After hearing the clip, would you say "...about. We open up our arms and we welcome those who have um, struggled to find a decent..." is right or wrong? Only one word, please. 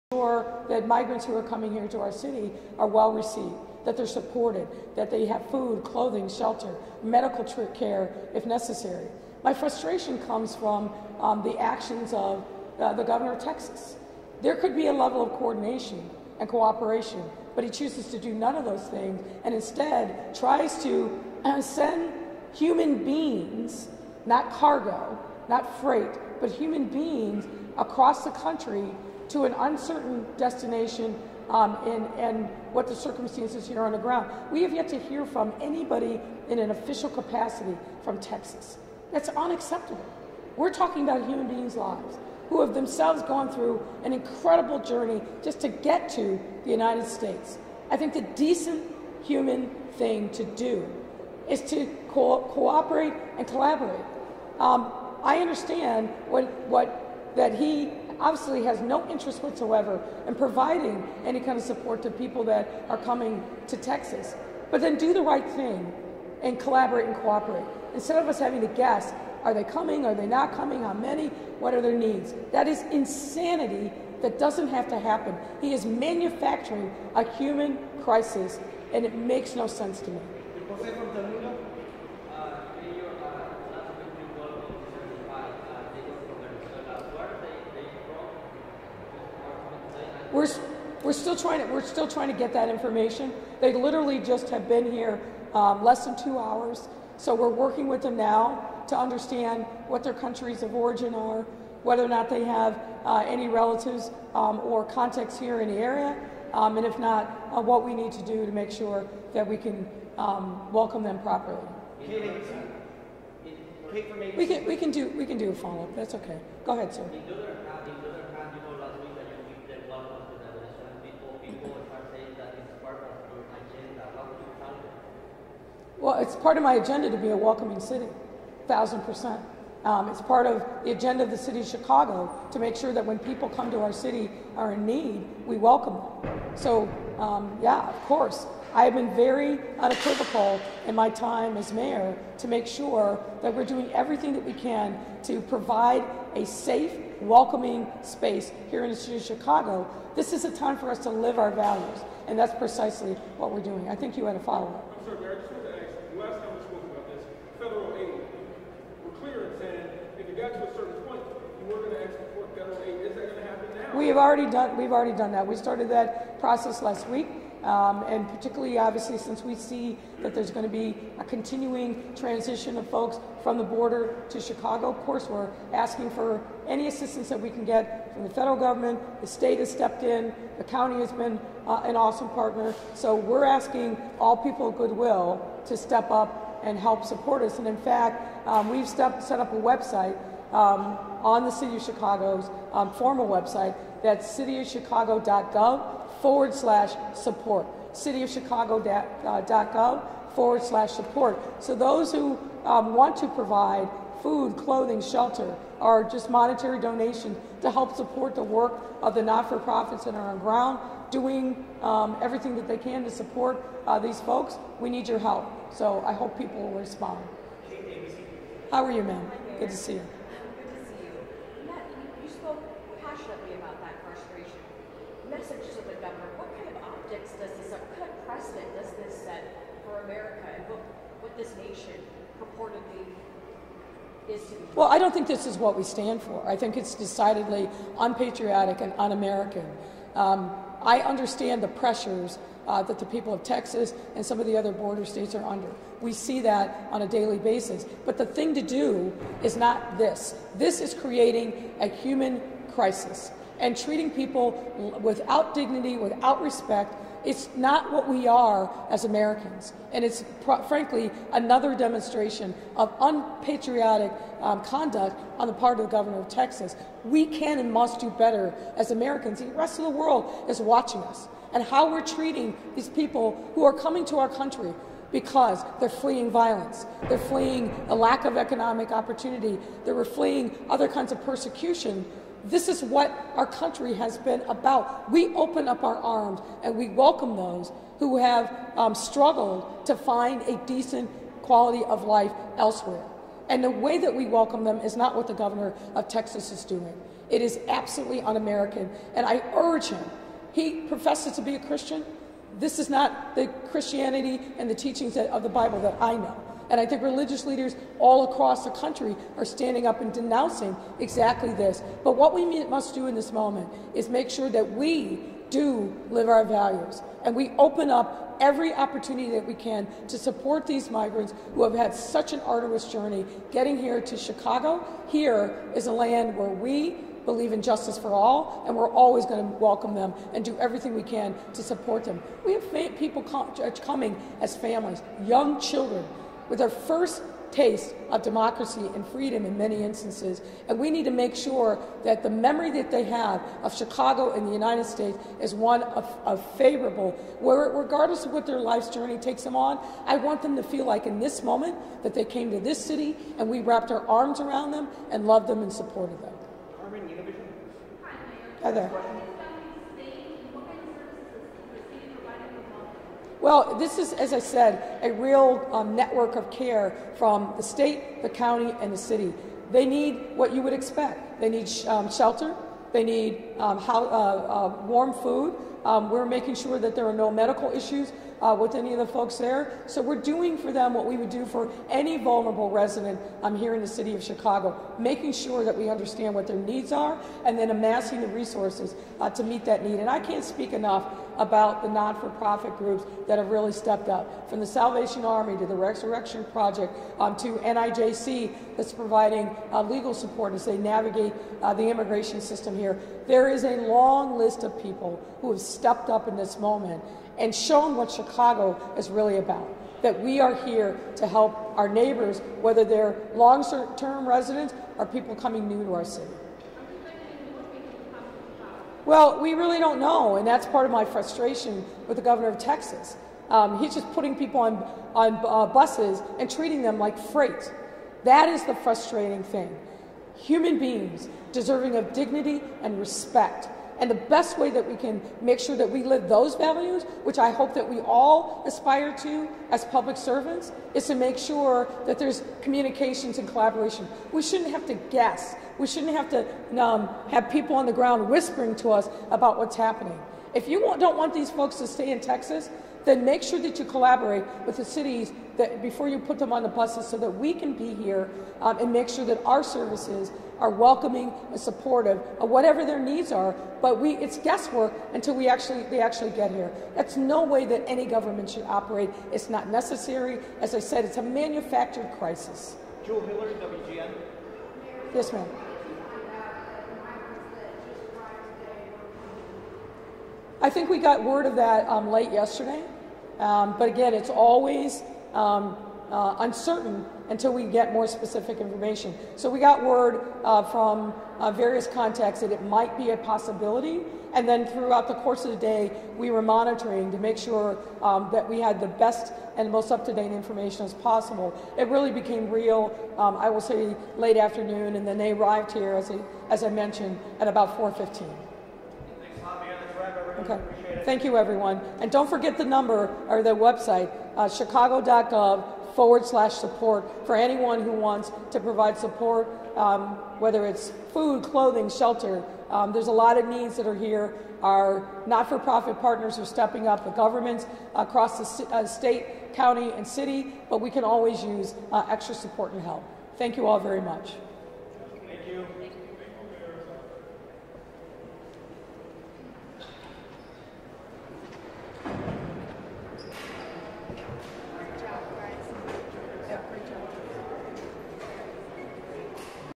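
right.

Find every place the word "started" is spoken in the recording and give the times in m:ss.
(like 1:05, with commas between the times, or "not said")
2:45.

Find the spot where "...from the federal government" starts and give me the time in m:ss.
2:58.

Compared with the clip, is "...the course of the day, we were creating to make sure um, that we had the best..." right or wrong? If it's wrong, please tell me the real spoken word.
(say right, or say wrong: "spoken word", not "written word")
wrong: "monitoring", not "creating".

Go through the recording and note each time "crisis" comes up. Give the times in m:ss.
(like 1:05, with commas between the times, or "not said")
1:18, 4:12, 7:52.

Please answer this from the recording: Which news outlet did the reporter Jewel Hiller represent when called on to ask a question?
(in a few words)
WGN.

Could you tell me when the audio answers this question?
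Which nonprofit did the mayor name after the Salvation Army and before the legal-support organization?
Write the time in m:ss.
6:35.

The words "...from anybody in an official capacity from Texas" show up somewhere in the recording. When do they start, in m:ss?
0:35.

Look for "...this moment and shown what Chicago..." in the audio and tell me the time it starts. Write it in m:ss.
6:46.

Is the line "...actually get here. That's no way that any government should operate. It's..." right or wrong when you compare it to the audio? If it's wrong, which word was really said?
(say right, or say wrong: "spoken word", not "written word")
right.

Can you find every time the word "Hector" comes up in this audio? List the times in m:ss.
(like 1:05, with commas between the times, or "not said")
not said.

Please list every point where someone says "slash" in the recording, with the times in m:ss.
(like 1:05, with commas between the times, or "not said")
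3:16, 3:20, 8:36.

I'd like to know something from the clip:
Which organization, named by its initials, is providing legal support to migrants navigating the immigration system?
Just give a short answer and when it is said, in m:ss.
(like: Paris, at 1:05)
NIJC, at 6:37.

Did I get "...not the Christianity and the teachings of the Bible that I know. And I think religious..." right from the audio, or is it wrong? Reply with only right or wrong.
right.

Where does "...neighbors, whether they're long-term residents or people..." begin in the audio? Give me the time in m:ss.
6:51.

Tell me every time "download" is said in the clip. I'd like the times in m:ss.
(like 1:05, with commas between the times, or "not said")
not said.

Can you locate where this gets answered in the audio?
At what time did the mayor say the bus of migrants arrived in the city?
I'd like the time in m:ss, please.
8:27.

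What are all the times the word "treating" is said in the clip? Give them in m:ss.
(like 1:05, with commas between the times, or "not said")
4:13, 4:32, 7:06.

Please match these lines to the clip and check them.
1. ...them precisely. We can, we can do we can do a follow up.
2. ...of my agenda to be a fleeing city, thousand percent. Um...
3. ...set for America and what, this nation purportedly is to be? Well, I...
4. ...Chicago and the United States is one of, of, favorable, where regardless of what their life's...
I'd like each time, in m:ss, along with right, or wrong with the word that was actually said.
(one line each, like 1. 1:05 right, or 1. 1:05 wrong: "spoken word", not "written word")
1. 1:51 wrong: "properly", not "precisely"
2. 2:06 wrong: "welcoming", not "fleeing"
3. 3:49 right
4. 5:43 right.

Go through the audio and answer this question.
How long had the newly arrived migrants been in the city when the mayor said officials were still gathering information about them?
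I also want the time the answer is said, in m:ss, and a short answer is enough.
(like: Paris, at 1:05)
less than two hours, at 1:35.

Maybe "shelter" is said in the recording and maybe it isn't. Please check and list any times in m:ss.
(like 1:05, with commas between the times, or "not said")
0:06, 3:25, 6:12, 8:41.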